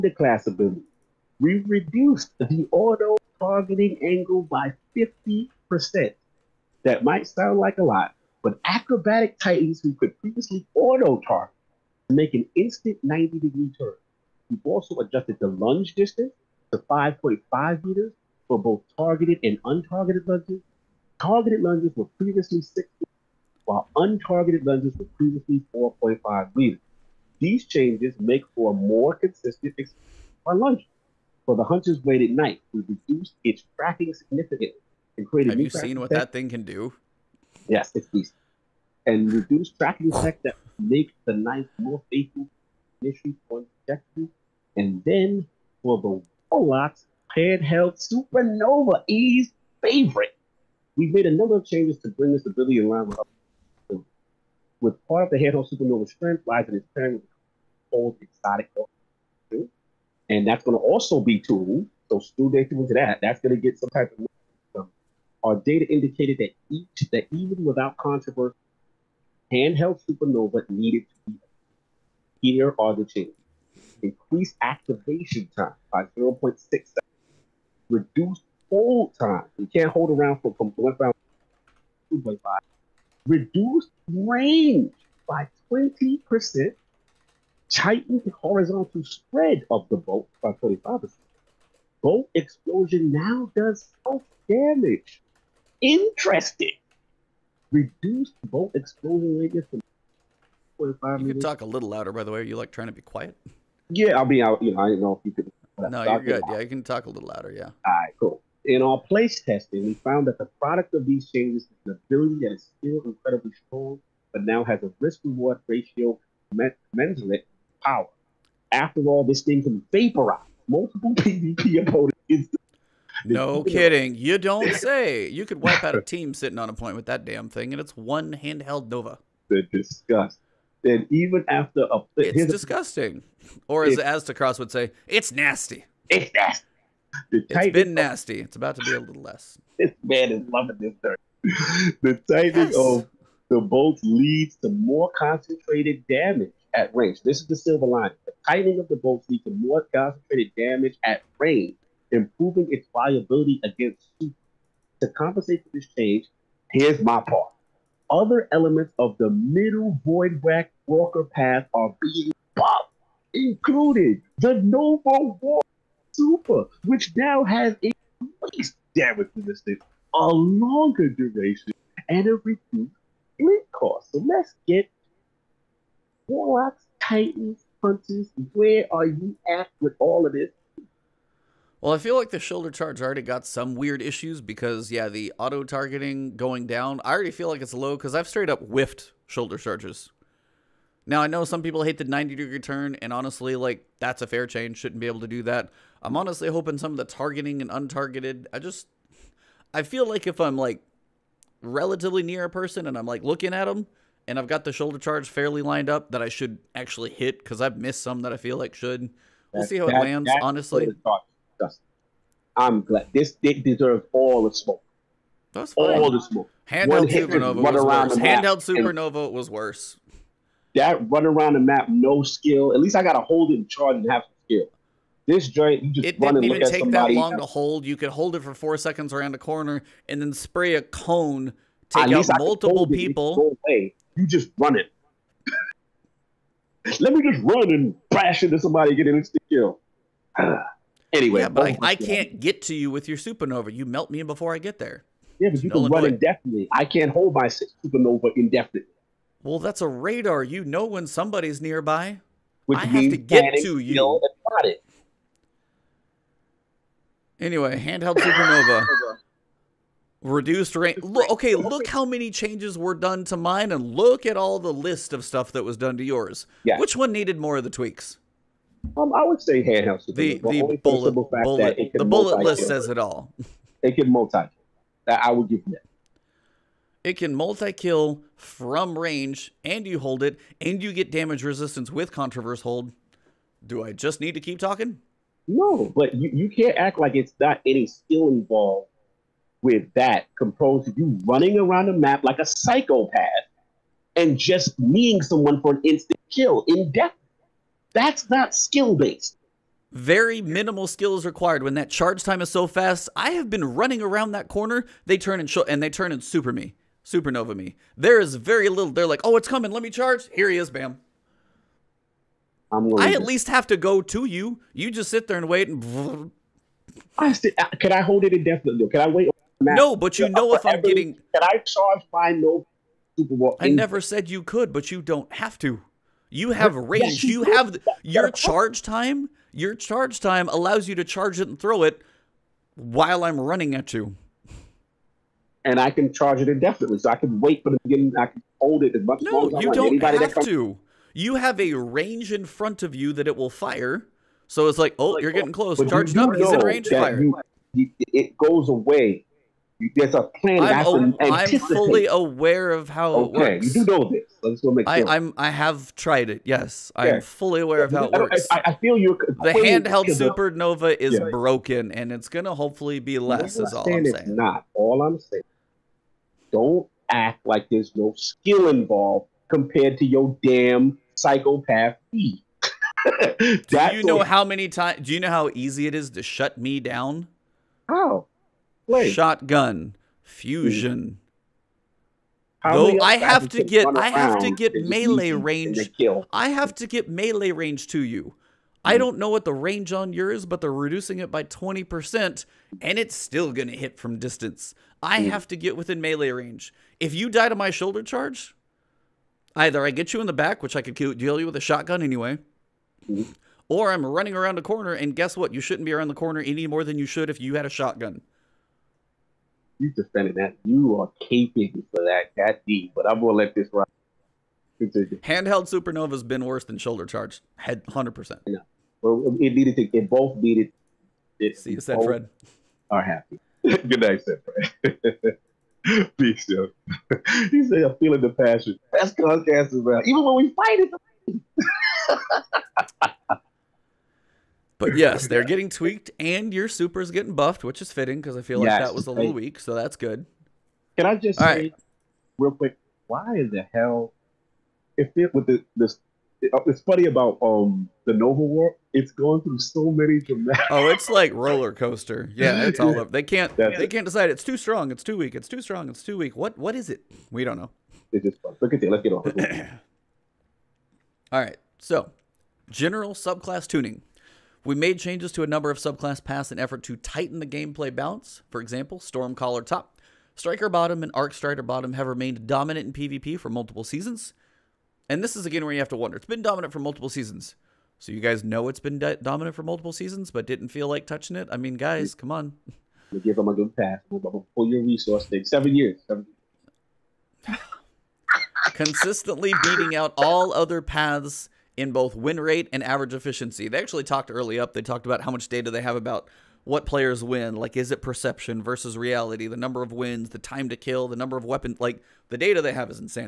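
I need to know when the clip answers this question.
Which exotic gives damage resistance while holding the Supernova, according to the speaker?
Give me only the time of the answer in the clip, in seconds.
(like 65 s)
282 s.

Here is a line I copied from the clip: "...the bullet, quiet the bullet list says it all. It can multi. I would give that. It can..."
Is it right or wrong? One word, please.
wrong.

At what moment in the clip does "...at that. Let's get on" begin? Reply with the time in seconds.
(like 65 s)
458 s.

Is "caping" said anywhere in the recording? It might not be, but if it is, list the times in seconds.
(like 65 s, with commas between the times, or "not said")
411 s.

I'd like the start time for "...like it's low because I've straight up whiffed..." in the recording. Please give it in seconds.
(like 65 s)
187 s.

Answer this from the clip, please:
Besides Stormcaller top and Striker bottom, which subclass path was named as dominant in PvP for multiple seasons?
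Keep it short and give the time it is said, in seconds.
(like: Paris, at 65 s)
Arc Strider bottom, at 471 s.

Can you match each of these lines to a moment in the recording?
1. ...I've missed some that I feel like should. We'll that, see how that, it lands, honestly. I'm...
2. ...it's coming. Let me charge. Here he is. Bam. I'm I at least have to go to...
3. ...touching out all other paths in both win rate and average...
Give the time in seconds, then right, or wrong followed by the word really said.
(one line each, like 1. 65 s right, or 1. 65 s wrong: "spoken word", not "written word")
1. 207 s right
2. 309 s right
3. 489 s wrong: "beating", not "touching".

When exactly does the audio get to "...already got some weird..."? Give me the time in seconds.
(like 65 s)
183 s.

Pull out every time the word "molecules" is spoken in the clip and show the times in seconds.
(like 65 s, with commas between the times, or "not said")
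not said.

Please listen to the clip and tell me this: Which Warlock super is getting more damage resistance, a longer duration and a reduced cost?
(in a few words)
Nova Warp.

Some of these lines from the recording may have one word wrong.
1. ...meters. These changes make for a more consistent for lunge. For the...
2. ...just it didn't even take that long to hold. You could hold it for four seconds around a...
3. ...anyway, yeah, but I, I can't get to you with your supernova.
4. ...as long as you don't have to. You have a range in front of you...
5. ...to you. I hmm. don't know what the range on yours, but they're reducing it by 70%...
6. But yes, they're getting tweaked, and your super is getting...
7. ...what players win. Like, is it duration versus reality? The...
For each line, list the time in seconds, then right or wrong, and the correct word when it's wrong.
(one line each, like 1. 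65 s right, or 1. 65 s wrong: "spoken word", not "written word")
1. 26 s right
2. 225 s right
3. 241 s right
4. 339 s right
5. 387 s wrong: "20", not "70"
6. 434 s right
7. 496 s wrong: "perception", not "duration".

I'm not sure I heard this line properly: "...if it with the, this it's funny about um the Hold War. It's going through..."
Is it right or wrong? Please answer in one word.
wrong.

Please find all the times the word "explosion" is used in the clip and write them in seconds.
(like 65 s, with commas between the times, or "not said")
92 s, 98 s.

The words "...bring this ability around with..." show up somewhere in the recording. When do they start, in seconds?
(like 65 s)
52 s.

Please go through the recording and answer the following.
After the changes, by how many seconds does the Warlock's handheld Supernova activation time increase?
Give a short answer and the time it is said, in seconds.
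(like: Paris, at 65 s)
0.6 seconds, at 76 s.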